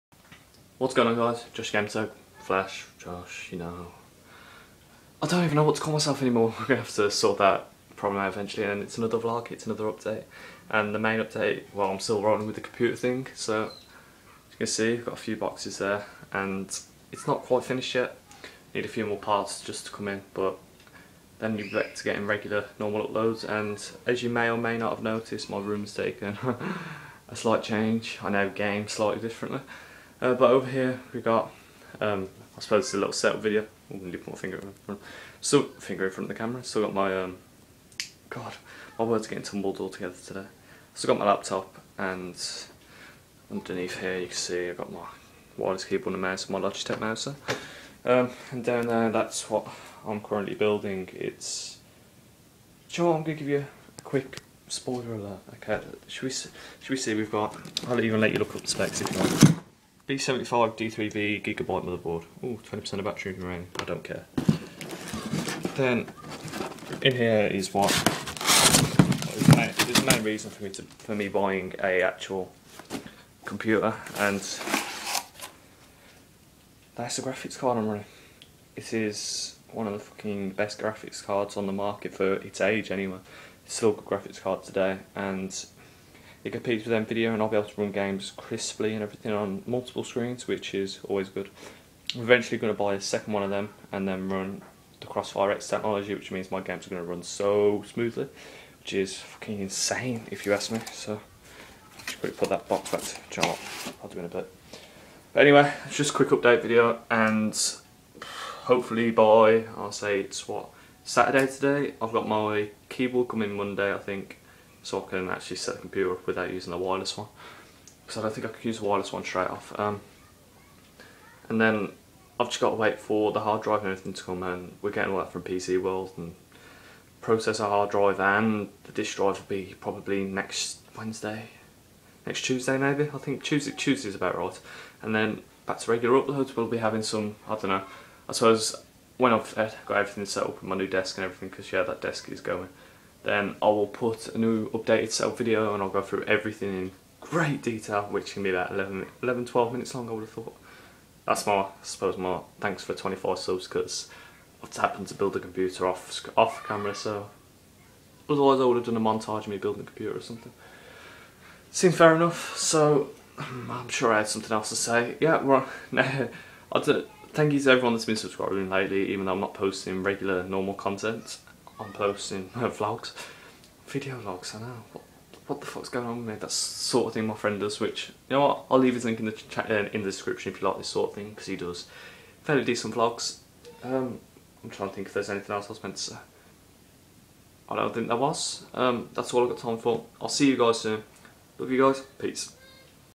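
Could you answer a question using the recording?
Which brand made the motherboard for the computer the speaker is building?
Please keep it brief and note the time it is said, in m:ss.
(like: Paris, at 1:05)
Gigabyte, at 1:01.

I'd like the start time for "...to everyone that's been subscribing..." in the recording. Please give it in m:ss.
2:47.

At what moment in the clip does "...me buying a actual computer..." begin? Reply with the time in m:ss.
1:11.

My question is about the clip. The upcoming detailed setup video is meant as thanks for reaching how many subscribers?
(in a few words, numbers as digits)
25.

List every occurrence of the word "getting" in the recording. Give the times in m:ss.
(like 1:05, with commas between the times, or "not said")
0:22, 0:39, 2:04.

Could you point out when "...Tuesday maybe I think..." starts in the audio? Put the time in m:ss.
2:12.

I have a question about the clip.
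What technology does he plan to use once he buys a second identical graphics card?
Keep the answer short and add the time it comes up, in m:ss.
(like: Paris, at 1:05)
Crossfire X, at 1:35.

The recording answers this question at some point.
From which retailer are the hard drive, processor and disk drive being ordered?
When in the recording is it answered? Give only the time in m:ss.
2:05.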